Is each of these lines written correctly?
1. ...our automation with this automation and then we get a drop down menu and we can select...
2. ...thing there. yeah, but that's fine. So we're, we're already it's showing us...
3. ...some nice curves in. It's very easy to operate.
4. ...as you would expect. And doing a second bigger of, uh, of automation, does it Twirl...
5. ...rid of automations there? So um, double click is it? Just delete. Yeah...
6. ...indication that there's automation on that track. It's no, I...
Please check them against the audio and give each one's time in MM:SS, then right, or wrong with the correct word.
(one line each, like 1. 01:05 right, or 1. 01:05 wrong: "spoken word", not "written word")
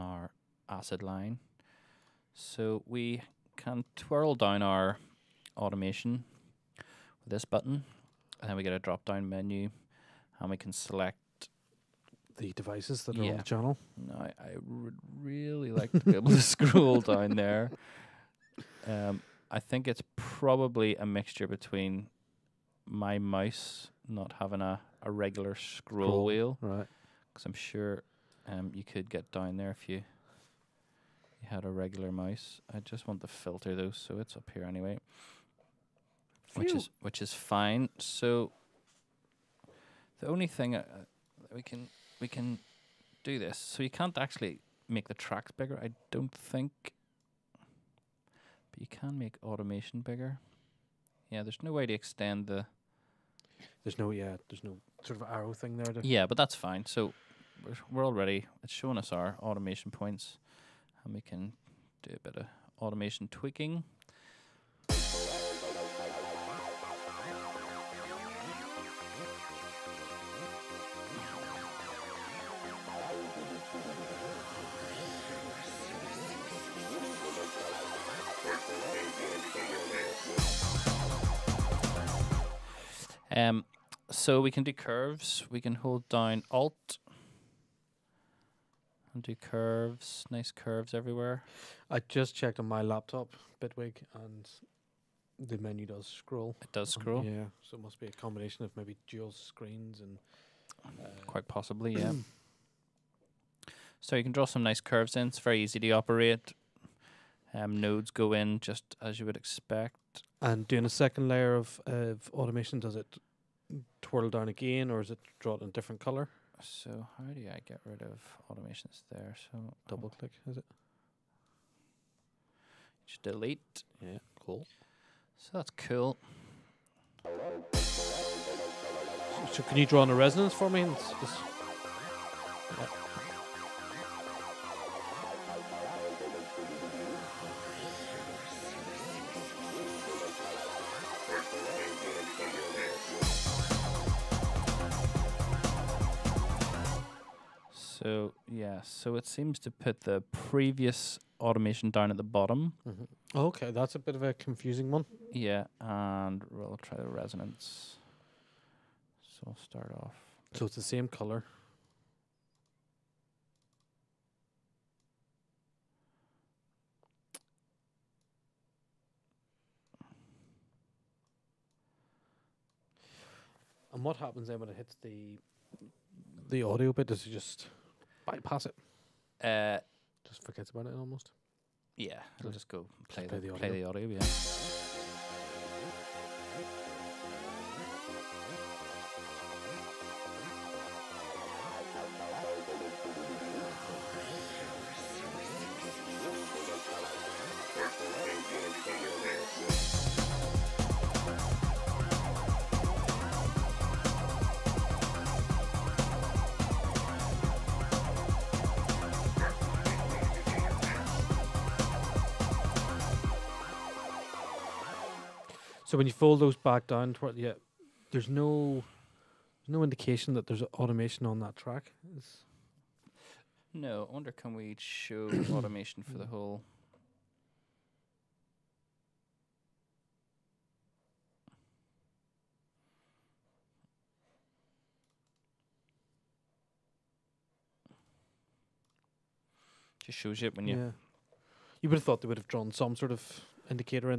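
1. 00:04 wrong: "button", not "automation"
2. 00:55 right
3. 01:44 right
4. 01:49 wrong: "layer", not "bigger"
5. 01:57 right
6. 03:39 right.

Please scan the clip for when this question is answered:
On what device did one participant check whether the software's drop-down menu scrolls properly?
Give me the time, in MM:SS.
01:32.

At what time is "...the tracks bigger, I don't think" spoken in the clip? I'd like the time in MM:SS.
00:45.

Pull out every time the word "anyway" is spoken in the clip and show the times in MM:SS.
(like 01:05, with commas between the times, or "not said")
00:34.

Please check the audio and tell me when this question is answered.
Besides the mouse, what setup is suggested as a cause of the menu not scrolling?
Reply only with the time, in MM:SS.
01:39.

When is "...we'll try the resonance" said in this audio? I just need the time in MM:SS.
02:36.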